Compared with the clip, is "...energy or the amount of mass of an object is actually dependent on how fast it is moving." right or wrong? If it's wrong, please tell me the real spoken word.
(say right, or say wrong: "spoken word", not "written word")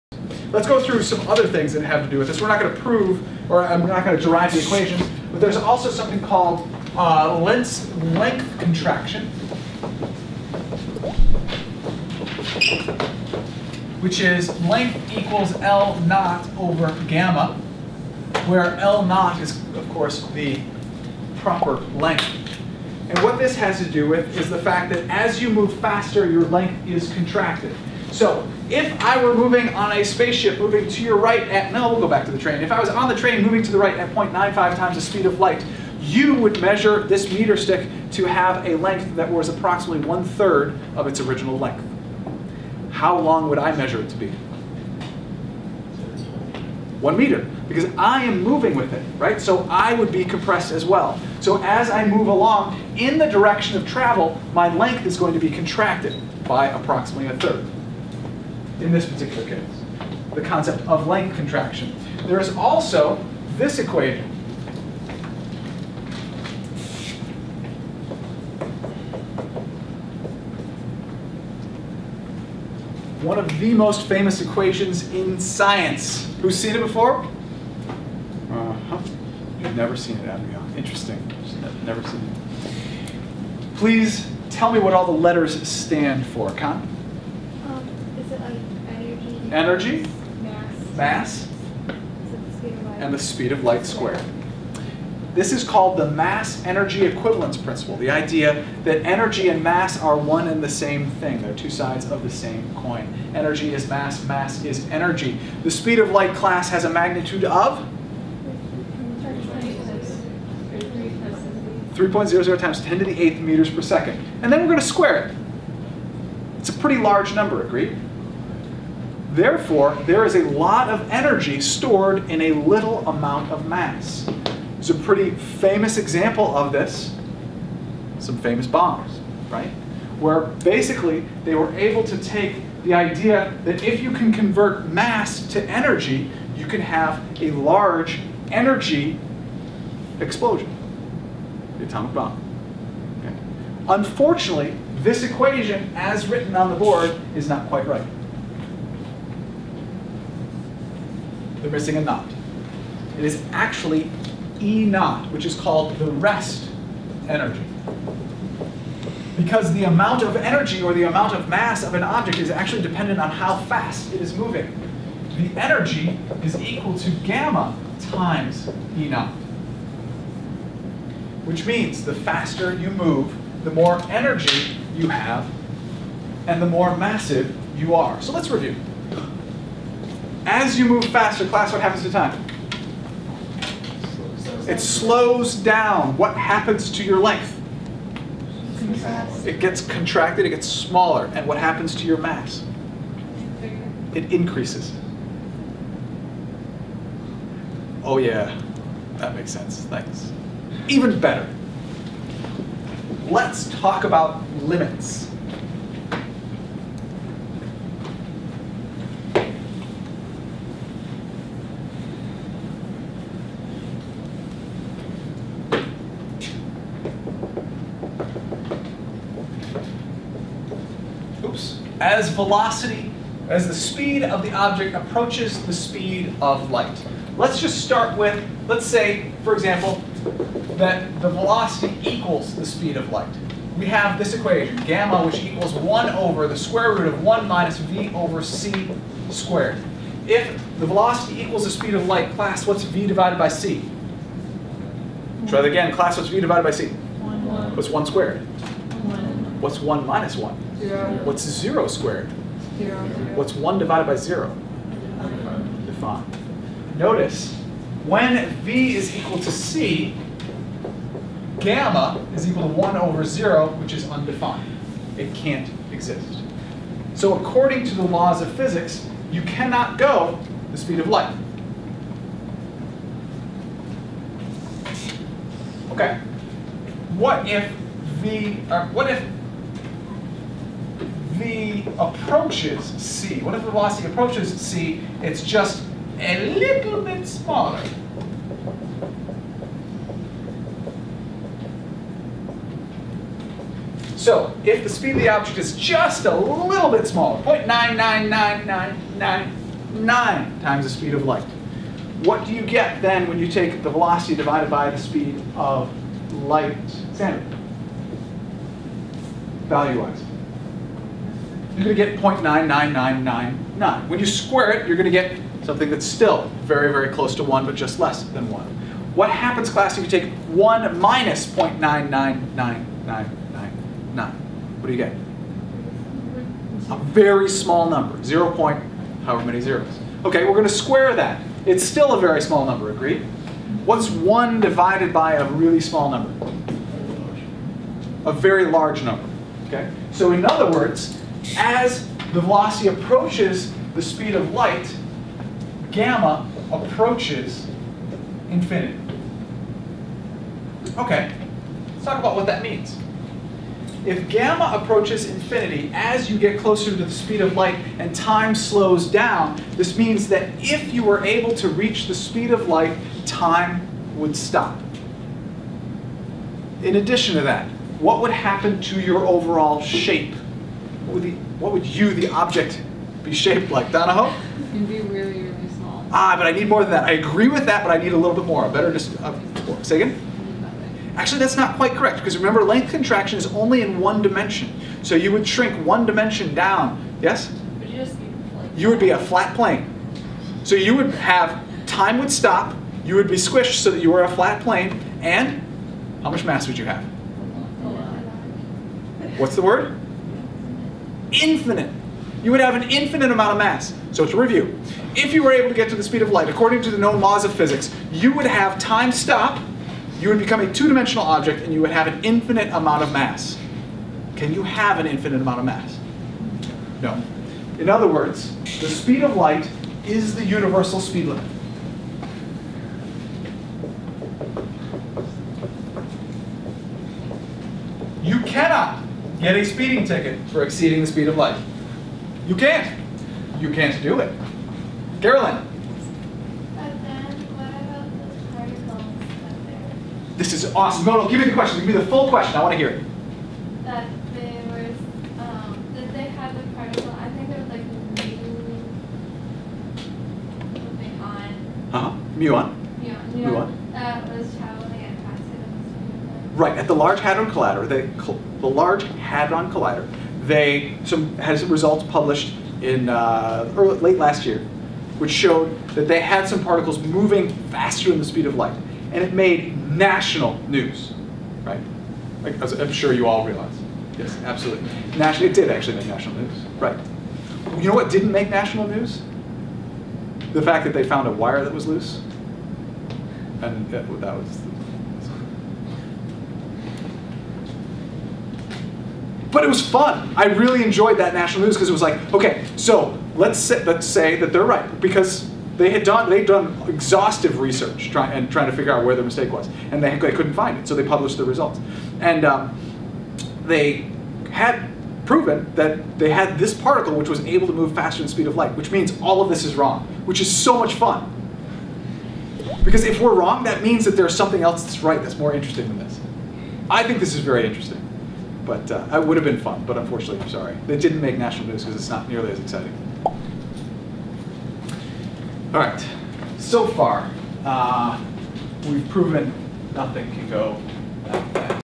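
right.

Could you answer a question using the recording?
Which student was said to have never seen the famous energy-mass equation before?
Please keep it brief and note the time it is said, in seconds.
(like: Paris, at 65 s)
Adrian, at 80 s.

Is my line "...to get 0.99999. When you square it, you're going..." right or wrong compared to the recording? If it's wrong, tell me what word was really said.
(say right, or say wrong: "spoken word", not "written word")
right.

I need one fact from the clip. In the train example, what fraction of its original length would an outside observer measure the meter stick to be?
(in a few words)
one third.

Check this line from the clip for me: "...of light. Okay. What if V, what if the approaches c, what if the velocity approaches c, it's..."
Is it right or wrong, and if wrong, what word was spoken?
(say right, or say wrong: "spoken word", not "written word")
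right.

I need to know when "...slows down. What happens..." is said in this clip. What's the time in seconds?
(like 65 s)
184 s.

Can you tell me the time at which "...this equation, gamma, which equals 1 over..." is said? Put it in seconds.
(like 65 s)
234 s.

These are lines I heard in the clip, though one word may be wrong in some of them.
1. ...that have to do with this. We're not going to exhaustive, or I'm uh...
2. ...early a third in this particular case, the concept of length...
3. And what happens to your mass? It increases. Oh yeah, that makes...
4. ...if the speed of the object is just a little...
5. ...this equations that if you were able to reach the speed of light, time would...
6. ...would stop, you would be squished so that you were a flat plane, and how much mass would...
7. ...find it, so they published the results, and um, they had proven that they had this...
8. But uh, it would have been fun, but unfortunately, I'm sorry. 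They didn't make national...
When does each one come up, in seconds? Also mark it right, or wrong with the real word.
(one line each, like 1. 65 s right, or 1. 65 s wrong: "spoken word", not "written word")
1. 1 s wrong: "prove", not "exhaustive"
2. 56 s wrong: "approximately", not "early"
3. 191 s right
4. 294 s right
5. 359 s wrong: "means", not "equations"
6. 392 s right
7. 500 s right
8. 518 s right.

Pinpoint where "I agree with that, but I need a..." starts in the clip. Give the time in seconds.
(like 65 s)
377 s.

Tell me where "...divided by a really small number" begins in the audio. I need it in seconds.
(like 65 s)
334 s.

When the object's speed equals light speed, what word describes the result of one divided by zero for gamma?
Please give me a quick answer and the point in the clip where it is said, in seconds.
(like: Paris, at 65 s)
undefined, at 264 s.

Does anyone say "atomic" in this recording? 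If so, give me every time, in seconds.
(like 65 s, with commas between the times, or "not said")
141 s.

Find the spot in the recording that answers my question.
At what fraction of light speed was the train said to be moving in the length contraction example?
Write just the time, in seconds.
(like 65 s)
34 s.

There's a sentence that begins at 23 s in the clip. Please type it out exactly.
And what this has to do with is the fact that as you move faster, your length is contracted.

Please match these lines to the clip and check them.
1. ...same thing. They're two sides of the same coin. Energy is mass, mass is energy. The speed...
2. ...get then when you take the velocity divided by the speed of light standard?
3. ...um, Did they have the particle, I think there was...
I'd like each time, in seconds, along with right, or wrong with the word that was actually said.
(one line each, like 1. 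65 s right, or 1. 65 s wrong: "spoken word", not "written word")
1. 100 s right
2. 302 s right
3. 445 s right.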